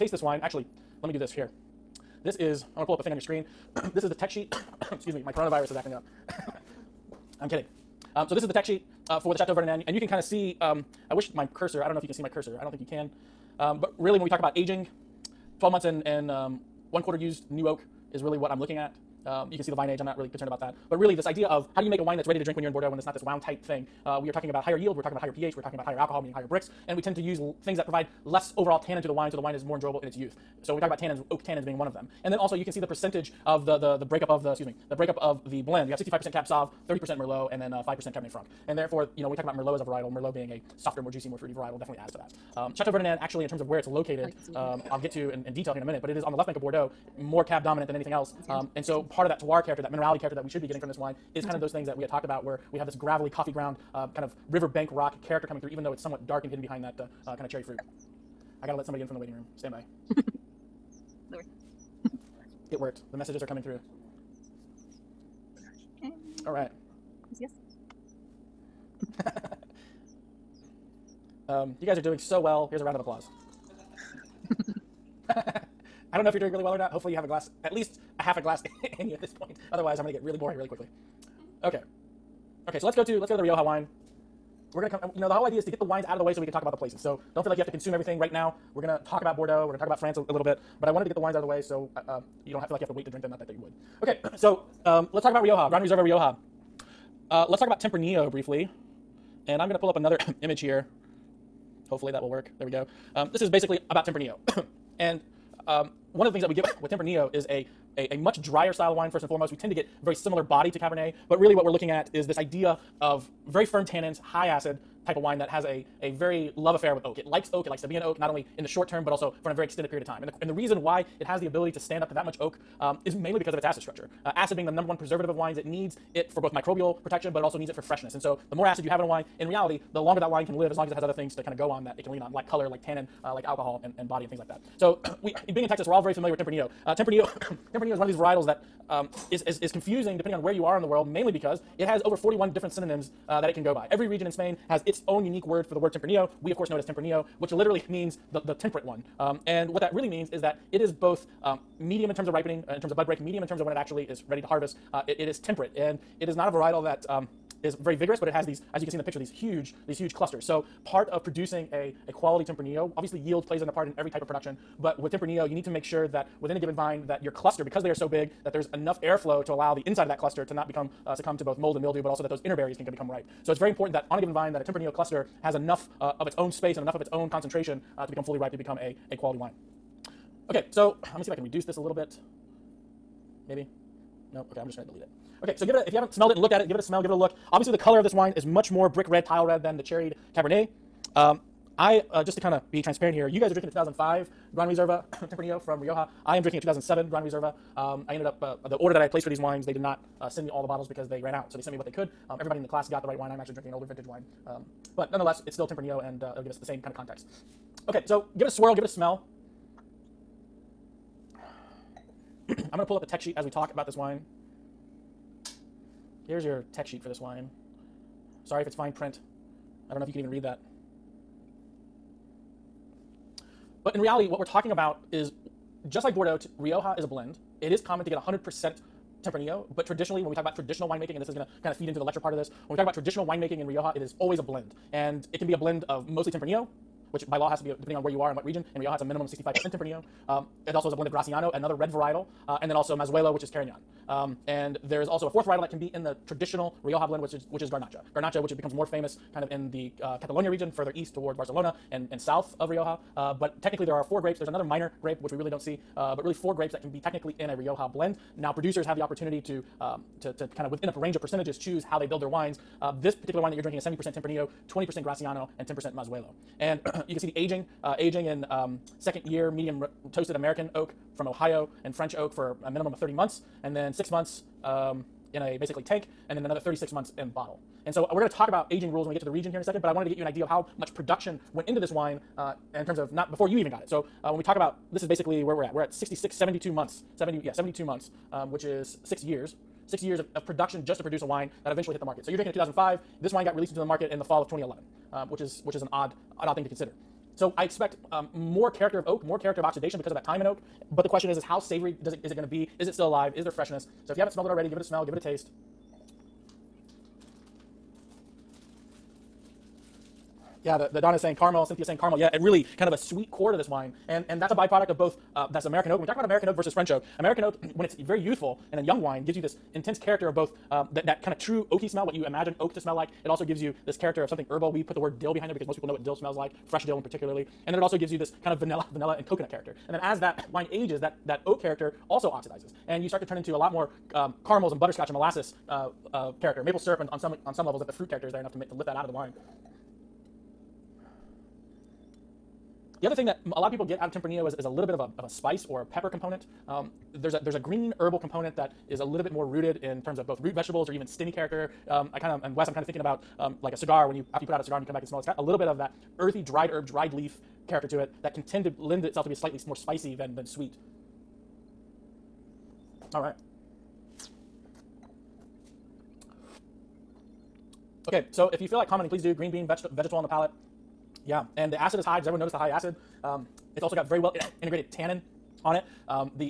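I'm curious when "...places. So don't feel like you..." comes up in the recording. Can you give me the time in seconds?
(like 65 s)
86 s.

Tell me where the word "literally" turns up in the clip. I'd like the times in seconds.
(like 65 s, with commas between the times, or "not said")
147 s.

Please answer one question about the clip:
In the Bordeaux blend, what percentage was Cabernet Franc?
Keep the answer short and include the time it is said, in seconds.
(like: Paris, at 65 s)
5%, at 37 s.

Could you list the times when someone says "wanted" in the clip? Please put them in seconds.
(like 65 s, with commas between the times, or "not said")
90 s, 279 s.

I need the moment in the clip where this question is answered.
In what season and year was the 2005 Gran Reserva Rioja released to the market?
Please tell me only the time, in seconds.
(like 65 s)
294 s.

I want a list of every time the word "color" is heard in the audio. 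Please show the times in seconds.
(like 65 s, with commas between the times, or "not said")
132 s, 187 s.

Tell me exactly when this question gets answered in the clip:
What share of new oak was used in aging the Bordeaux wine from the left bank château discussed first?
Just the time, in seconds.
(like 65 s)
16 s.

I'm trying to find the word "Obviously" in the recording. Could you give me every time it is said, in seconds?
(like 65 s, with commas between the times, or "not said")
162 s, 187 s.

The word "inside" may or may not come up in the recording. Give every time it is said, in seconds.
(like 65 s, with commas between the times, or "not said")
169 s.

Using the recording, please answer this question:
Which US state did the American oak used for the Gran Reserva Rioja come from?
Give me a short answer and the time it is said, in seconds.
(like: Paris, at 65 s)
Ohio, at 271 s.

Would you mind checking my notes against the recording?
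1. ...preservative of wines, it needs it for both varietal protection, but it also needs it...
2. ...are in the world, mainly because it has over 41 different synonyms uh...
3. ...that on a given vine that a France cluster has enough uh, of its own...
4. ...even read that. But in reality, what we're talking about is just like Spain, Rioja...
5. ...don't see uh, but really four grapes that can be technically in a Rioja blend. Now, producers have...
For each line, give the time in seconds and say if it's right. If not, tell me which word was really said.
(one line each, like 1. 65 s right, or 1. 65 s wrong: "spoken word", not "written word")
1. 124 s wrong: "microbial", not "varietal"
2. 140 s right
3. 173 s wrong: "Tempranillo", not "France"
4. 220 s wrong: "Bordeaux", not "Spain"
5. 255 s right.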